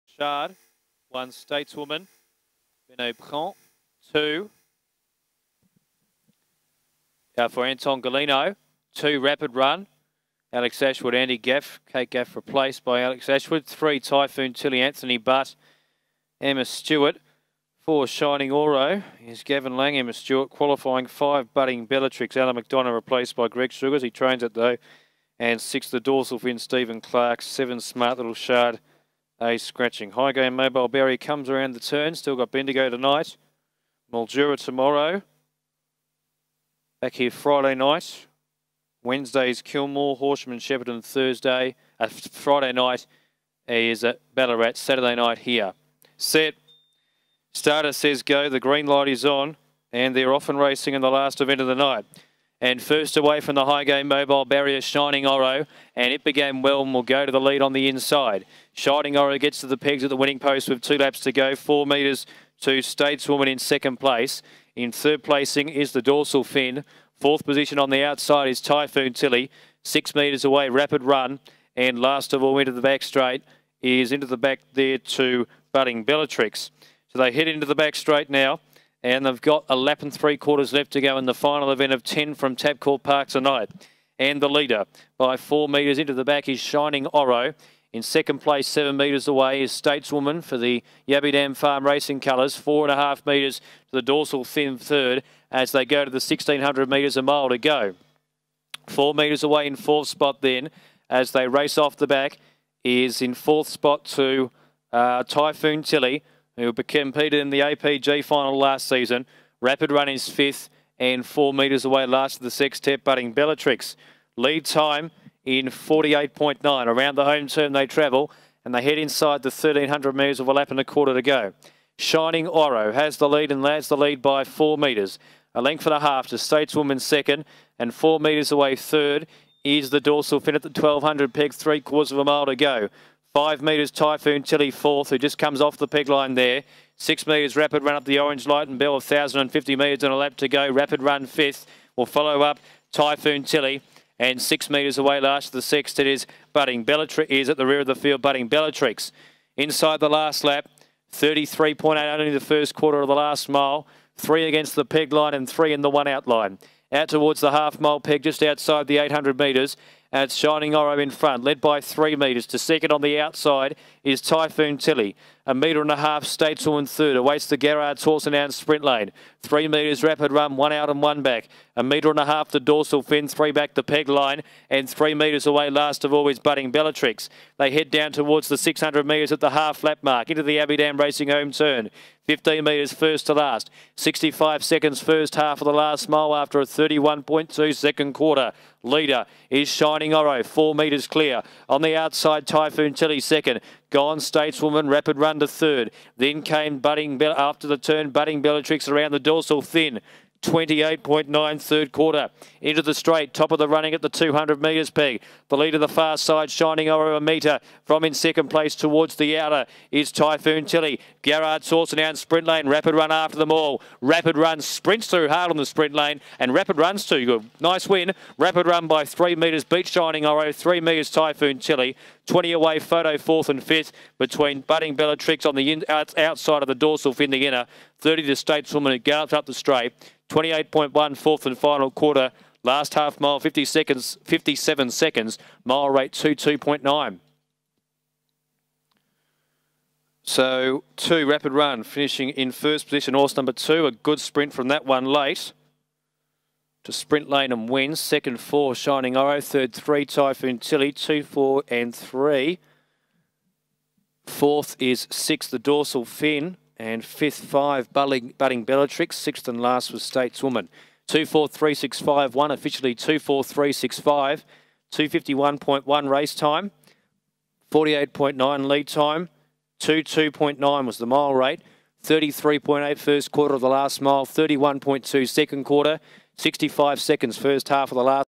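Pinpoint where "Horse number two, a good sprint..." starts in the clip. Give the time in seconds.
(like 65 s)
243 s.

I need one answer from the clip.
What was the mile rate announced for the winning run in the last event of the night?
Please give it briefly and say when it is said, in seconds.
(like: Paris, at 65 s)
22.9, at 235 s.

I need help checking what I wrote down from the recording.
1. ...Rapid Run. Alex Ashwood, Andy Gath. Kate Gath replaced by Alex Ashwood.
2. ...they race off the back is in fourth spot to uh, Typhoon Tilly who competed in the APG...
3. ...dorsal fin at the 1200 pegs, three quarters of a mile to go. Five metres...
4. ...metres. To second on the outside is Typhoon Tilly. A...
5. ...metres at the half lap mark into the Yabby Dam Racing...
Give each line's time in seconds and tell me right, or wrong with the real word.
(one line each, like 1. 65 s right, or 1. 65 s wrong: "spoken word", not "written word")
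1. 9 s right
2. 101 s right
3. 129 s right
4. 162 s right
5. 179 s right.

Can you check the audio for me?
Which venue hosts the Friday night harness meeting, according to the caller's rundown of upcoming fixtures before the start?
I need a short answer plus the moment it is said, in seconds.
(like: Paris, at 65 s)
Ballarat, at 44 s.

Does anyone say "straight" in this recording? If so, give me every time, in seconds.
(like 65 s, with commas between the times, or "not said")
73 s, 77 s, 202 s, 229 s.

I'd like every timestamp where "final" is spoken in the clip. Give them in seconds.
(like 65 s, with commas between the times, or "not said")
81 s, 108 s, 231 s.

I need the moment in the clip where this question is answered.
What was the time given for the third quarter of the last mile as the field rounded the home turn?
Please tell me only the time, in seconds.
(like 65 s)
200 s.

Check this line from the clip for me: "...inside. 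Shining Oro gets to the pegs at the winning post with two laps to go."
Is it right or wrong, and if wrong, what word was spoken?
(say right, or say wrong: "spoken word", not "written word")
right.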